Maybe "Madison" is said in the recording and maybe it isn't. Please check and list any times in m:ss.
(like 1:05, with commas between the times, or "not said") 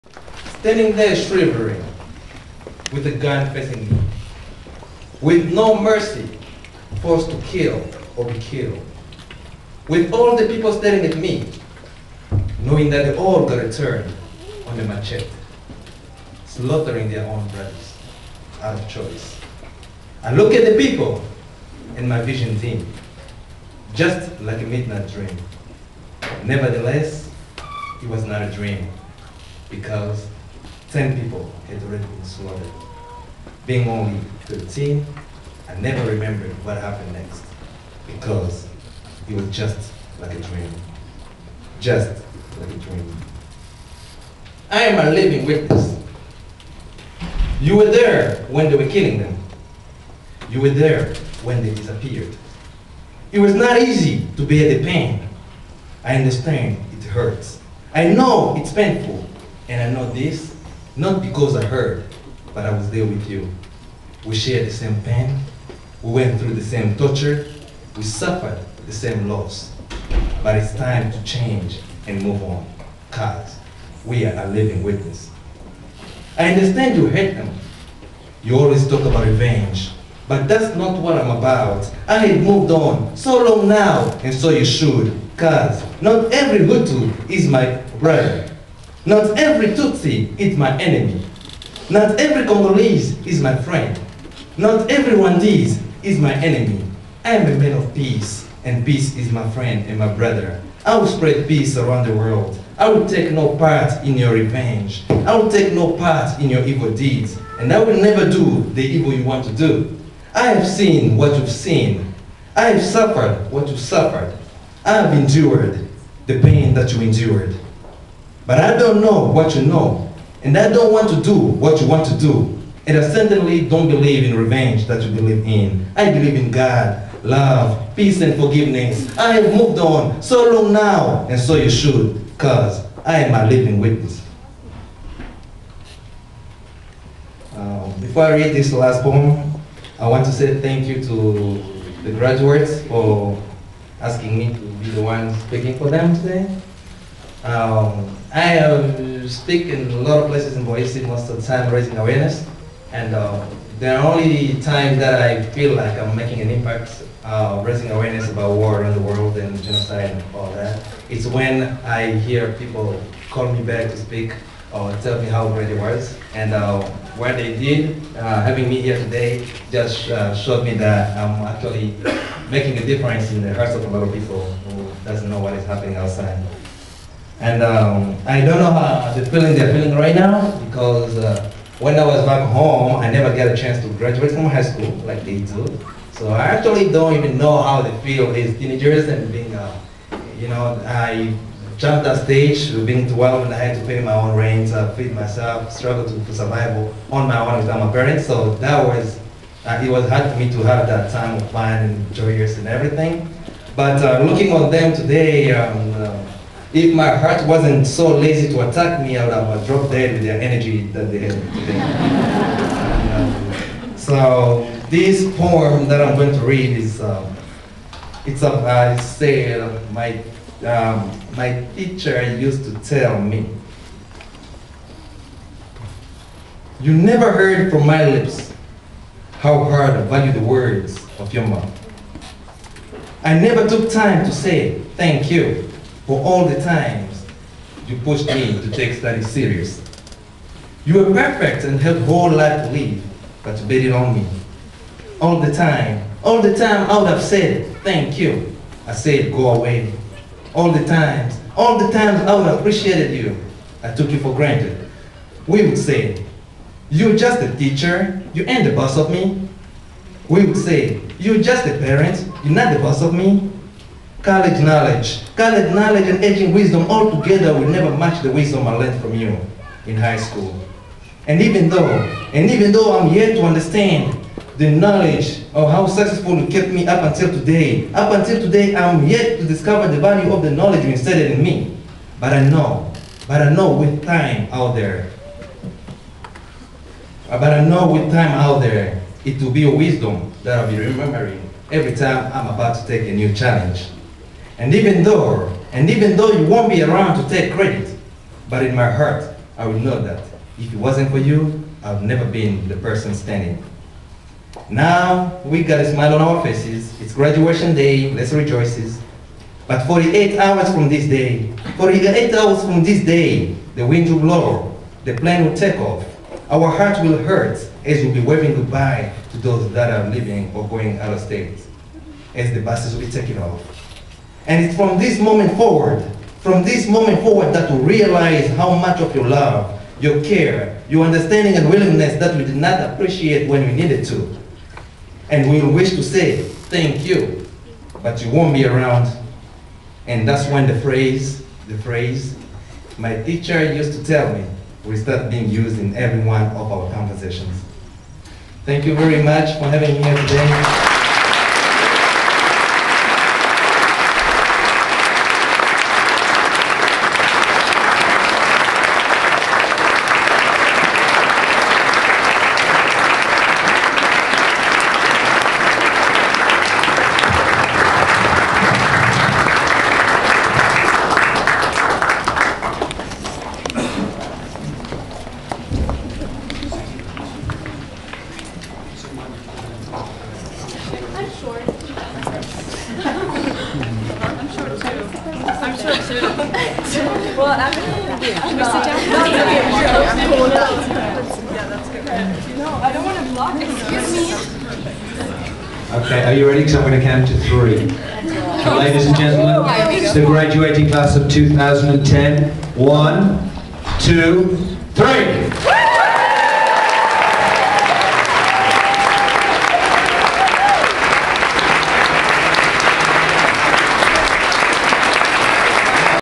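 not said.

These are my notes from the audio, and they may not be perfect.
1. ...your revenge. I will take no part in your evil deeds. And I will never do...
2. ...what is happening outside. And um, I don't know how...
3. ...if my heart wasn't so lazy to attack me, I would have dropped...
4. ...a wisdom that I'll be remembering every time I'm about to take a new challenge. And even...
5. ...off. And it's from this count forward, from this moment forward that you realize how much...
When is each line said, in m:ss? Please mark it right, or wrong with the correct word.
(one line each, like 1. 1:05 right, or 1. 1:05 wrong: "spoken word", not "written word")
1. 1:44 right
2. 2:55 right
3. 3:26 right
4. 4:49 right
5. 5:23 wrong: "moment", not "count".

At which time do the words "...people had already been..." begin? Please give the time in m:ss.
0:31.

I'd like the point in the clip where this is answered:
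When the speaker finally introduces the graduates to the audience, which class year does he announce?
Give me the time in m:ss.
6:41.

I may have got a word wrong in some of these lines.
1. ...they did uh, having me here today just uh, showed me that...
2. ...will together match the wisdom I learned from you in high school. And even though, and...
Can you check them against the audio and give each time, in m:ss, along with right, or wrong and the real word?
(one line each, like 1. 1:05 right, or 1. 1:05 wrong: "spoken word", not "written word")
1. 2:47 right
2. 4:27 wrong: "never", not "together".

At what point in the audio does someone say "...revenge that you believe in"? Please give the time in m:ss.
2:04.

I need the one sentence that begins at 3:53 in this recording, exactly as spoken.
I never took time to say thank you for all the times you pushed me to take study serious.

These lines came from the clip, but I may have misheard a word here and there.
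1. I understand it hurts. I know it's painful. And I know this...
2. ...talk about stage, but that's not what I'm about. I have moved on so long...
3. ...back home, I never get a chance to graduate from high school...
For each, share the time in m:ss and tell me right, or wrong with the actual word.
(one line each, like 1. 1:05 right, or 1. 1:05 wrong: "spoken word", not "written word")
1. 0:56 right
2. 1:18 wrong: "revenge", not "stage"
3. 3:02 right.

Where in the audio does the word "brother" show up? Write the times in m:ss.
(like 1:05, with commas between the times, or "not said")
0:17, 1:27, 1:40.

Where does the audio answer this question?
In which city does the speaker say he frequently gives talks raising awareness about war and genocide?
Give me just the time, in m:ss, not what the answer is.
2:30.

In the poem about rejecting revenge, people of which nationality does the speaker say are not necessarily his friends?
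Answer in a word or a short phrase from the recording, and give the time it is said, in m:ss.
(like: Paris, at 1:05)
Congolese, at 1:32.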